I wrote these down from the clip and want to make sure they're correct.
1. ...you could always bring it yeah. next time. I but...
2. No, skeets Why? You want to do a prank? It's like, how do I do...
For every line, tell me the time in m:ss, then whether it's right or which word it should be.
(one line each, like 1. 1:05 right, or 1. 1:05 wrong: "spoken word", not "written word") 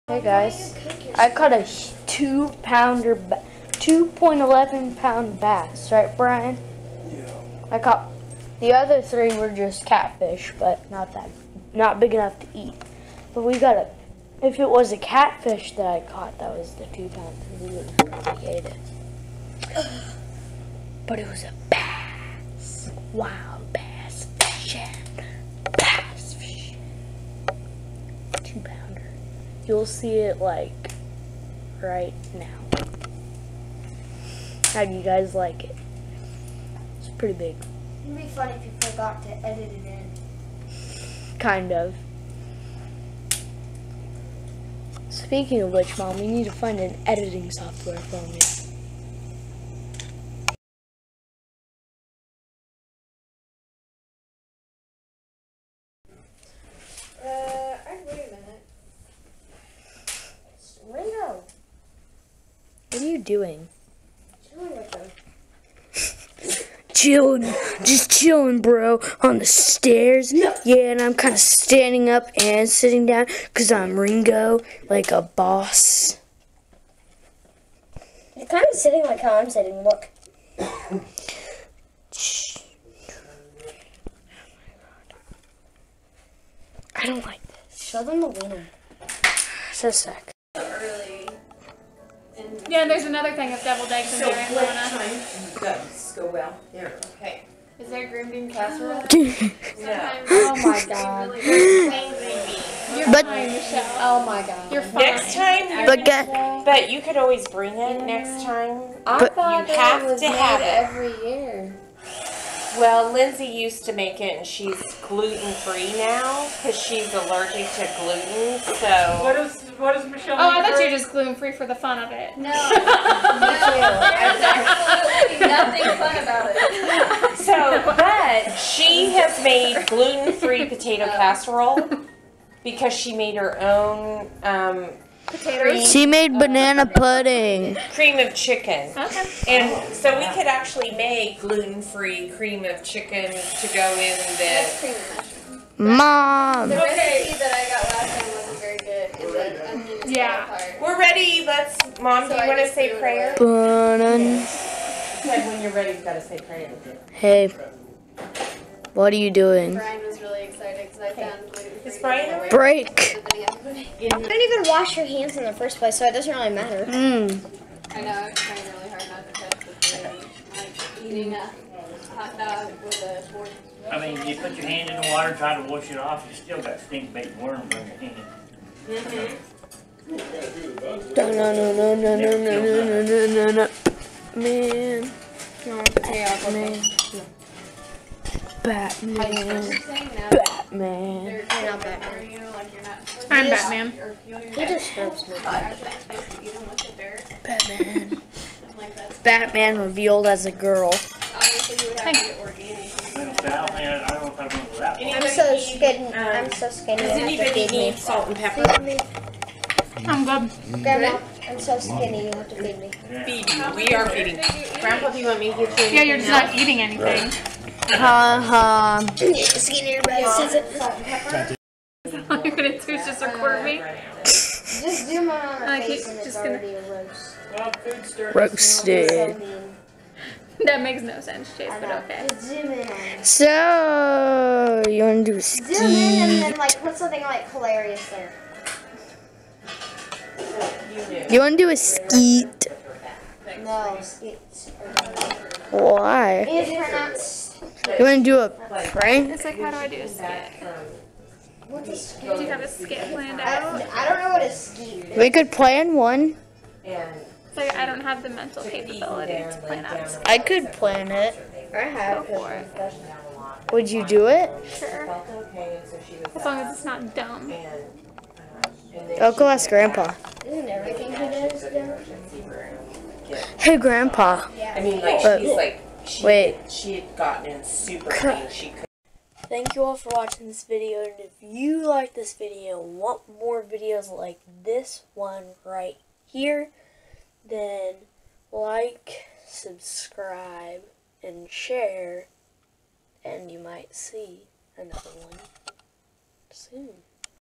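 1. 1:46 right
2. 4:03 right.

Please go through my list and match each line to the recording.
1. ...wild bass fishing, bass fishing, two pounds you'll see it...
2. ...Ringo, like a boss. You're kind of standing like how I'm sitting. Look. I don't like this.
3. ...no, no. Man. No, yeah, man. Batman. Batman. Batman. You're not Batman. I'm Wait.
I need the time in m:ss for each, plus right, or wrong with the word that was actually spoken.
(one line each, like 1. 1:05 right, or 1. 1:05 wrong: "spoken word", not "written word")
1. 0:23 right
2. 1:13 wrong: "sitting", not "standing"
3. 3:03 wrong: "Batman", not "Wait".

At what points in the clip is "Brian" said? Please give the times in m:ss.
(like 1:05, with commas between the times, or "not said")
0:06, 2:39.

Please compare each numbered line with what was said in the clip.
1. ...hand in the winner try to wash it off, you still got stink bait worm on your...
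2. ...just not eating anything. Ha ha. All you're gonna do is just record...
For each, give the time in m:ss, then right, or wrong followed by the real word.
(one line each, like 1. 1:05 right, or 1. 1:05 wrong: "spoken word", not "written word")
1. 2:54 wrong: "water", not "winner"
2. 3:36 right.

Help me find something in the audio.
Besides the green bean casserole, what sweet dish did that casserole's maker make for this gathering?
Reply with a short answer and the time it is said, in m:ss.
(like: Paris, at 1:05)
Banana pudding, at 2:16.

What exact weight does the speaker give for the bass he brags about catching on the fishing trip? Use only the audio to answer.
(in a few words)
2.11 pounds.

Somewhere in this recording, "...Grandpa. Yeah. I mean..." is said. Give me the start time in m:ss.
4:33.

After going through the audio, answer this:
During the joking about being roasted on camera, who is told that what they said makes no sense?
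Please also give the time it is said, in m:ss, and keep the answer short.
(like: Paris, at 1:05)
Chase, at 3:51.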